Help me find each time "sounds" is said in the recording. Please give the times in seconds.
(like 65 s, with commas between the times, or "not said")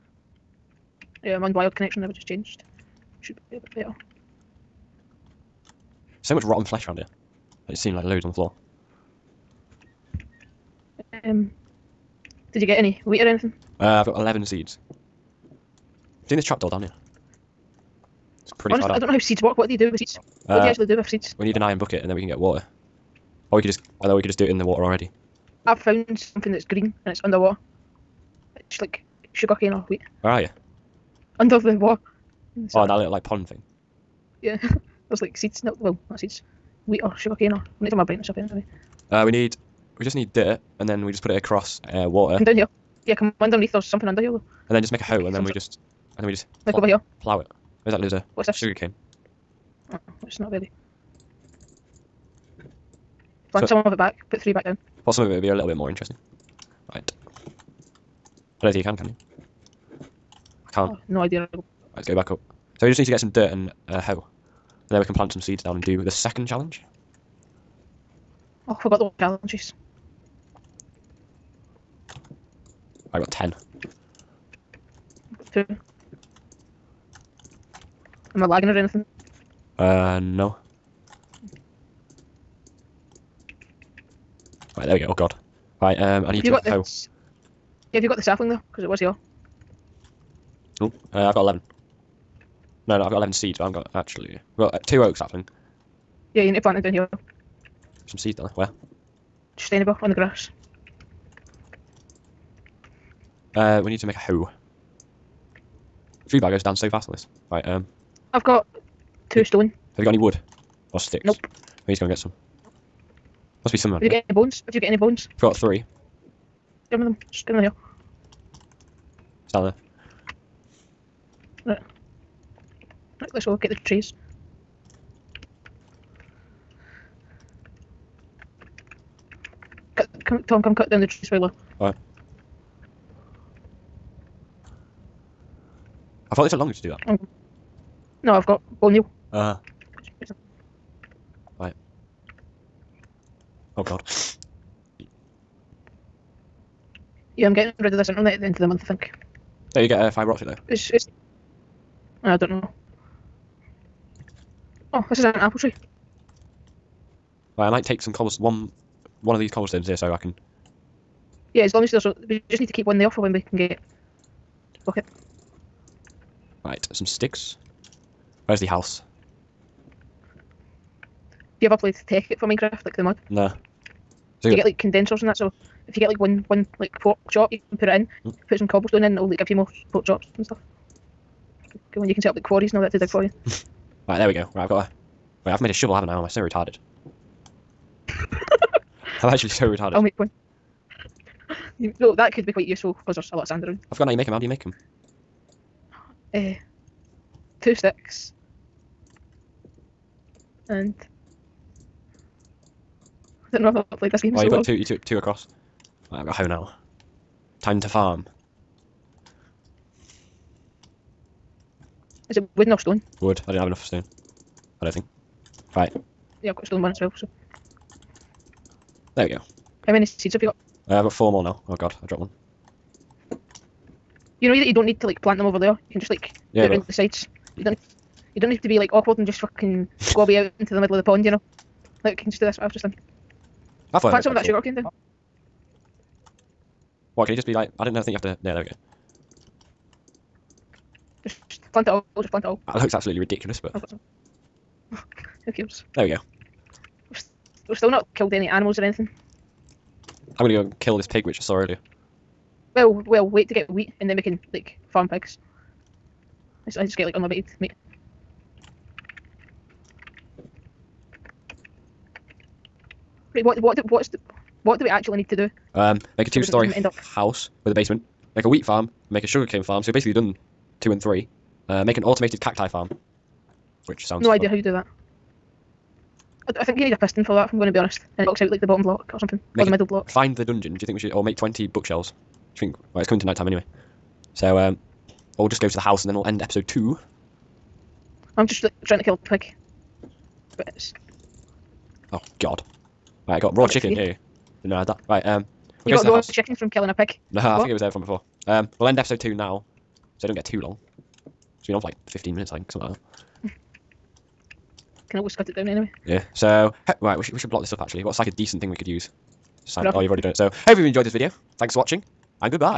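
274 s.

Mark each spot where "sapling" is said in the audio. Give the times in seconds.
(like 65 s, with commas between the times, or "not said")
88 s, 95 s.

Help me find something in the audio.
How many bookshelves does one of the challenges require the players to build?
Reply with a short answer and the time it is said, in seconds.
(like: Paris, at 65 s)
20, at 281 s.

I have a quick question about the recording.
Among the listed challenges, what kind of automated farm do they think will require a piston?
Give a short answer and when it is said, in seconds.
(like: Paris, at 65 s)
cacti farm, at 272 s.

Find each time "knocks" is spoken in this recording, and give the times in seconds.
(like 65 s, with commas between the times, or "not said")
278 s.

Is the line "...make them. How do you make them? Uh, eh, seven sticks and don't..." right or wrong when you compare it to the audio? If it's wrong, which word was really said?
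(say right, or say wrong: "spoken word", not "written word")
wrong: "two", not "seven".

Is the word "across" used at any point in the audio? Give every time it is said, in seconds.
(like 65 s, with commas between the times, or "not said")
41 s, 205 s.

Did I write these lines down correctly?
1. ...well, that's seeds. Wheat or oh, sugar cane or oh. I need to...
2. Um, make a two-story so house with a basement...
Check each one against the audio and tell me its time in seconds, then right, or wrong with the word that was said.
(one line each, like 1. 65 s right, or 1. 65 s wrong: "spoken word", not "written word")
1. 35 s right
2. 265 s right.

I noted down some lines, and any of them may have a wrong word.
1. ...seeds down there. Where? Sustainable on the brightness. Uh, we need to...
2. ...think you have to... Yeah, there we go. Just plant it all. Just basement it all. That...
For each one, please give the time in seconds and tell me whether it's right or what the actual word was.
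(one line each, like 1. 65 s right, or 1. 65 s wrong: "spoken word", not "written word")
1. 98 s wrong: "grass", not "brightness"
2. 238 s wrong: "plant", not "basement".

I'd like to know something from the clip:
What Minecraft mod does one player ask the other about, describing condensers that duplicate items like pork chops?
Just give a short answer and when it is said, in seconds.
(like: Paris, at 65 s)
Tekkit, at 172 s.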